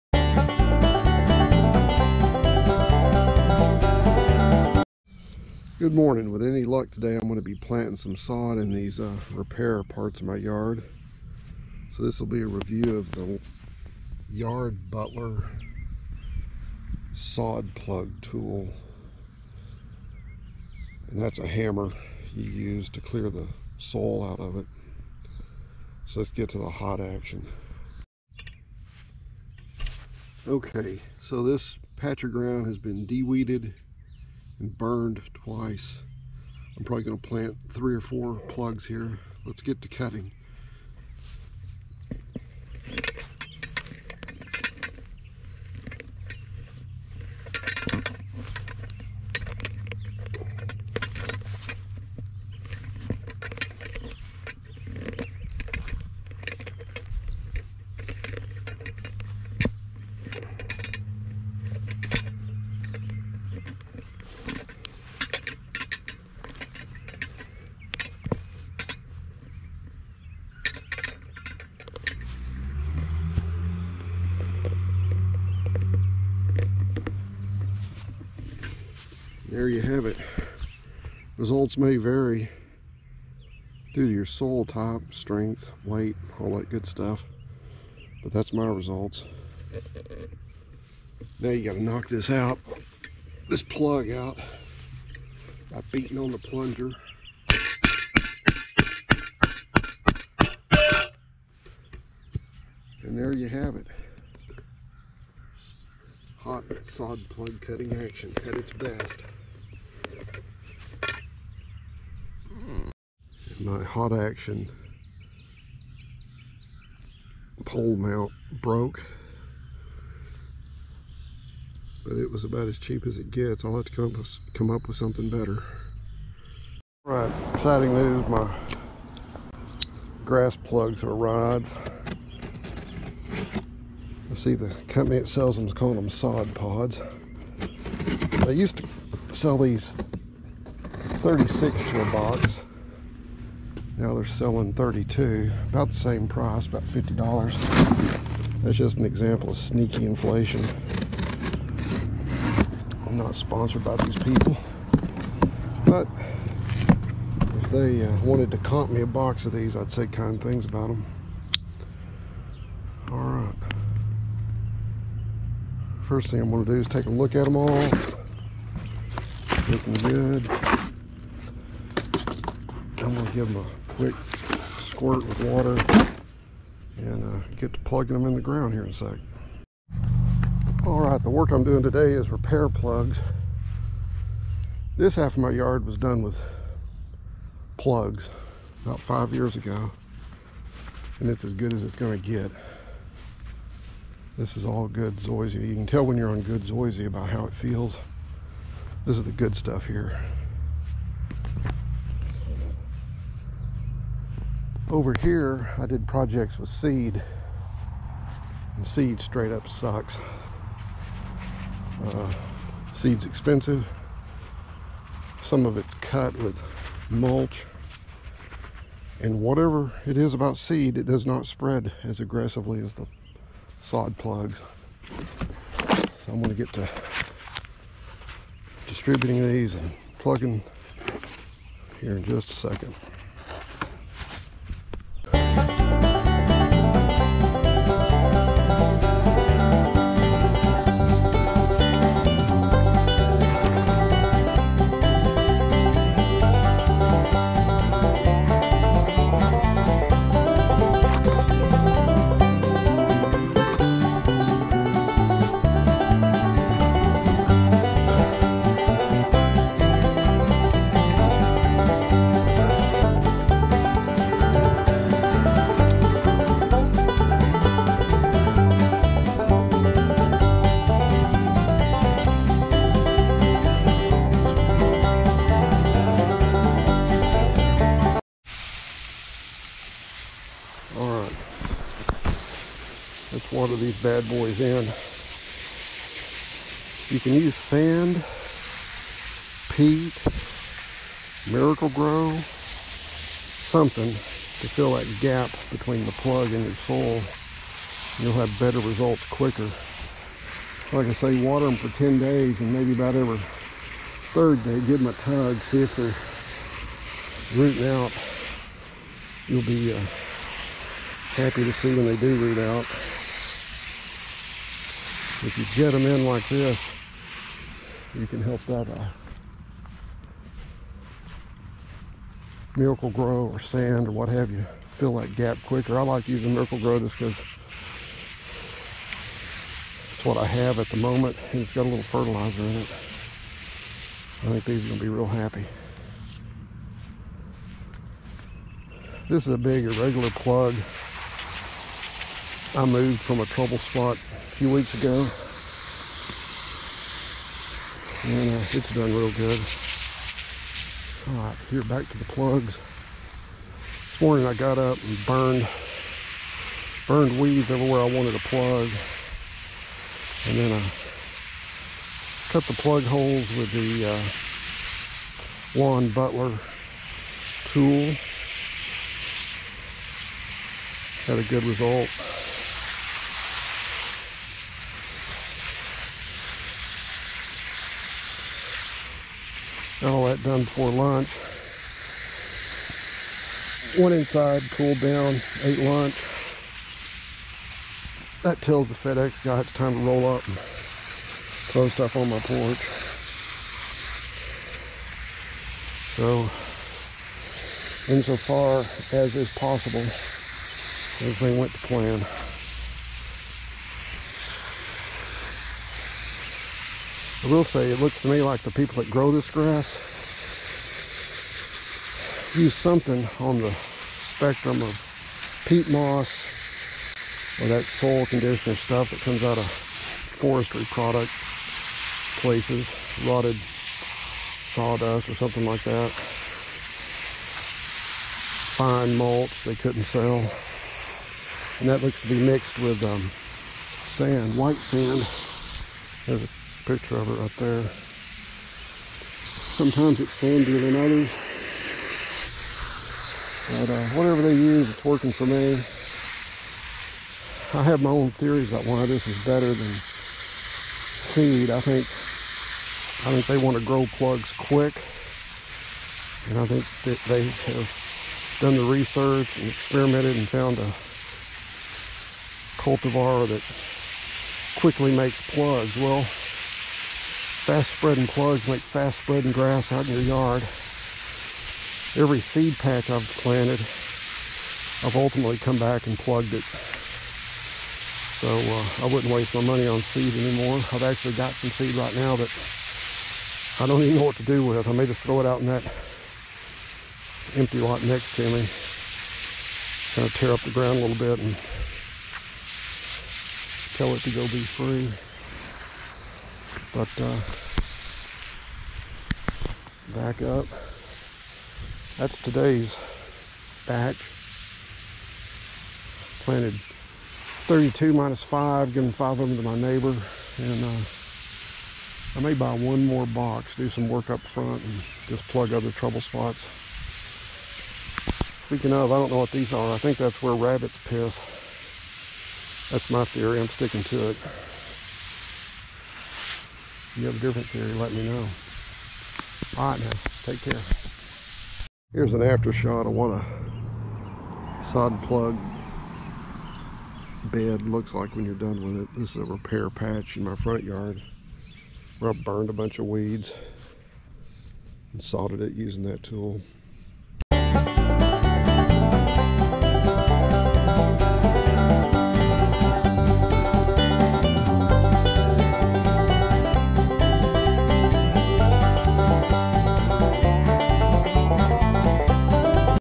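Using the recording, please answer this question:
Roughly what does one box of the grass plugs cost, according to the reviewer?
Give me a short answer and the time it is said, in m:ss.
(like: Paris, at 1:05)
$50, at 2:26.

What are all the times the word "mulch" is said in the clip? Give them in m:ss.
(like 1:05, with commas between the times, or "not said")
3:37, 7:09.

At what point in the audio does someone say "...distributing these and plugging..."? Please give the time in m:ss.
3:48.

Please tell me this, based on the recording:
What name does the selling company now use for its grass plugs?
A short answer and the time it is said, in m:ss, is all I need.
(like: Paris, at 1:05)
sod pods, at 2:16.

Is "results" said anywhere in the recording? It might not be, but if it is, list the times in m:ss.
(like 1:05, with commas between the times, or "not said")
1:21, 1:28, 4:58, 6:11.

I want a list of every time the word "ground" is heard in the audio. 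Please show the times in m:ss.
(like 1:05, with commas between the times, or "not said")
0:32, 2:58, 8:10.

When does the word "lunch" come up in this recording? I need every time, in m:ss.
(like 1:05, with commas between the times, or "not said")
6:20, 6:25.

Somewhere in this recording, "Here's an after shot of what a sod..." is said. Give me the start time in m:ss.
8:52.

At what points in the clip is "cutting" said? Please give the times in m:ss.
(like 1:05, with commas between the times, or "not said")
0:39, 1:47.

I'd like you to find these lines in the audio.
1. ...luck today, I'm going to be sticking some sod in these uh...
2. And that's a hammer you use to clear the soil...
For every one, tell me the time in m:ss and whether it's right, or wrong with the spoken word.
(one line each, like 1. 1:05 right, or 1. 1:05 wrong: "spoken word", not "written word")
1. 0:06 wrong: "planting", not "sticking"
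2. 0:21 right.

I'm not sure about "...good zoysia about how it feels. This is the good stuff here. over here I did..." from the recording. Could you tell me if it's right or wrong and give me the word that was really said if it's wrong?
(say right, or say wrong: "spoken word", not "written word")
right.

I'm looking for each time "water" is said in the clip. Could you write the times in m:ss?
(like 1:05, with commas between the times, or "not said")
2:55, 5:01.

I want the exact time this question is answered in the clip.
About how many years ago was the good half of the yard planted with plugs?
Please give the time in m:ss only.
3:08.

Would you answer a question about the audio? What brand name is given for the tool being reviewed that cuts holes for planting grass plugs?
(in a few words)
Yard Butler.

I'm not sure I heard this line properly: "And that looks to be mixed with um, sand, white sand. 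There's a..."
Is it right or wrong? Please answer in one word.
right.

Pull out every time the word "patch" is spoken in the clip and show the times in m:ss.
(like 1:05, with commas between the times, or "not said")
0:31, 7:52, 8:59.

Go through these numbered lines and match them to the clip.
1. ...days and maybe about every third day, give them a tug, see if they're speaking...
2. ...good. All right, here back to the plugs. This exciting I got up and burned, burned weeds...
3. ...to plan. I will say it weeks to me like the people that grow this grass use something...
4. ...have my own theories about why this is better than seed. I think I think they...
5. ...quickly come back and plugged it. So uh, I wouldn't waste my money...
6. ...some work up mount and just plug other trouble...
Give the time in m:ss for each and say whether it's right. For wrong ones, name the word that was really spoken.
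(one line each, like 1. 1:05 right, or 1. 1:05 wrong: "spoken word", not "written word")
1. 5:02 wrong: "rooting", not "speaking"
2. 5:49 wrong: "morning", not "exciting"
3. 6:41 wrong: "looks", not "weeks"
4. 7:27 right
5. 7:55 wrong: "ultimately", not "quickly"
6. 8:33 wrong: "front", not "mount".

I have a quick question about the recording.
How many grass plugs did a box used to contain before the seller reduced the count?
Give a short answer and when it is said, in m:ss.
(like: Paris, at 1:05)
36, at 2:21.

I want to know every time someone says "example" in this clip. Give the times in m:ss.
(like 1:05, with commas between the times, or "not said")
2:29.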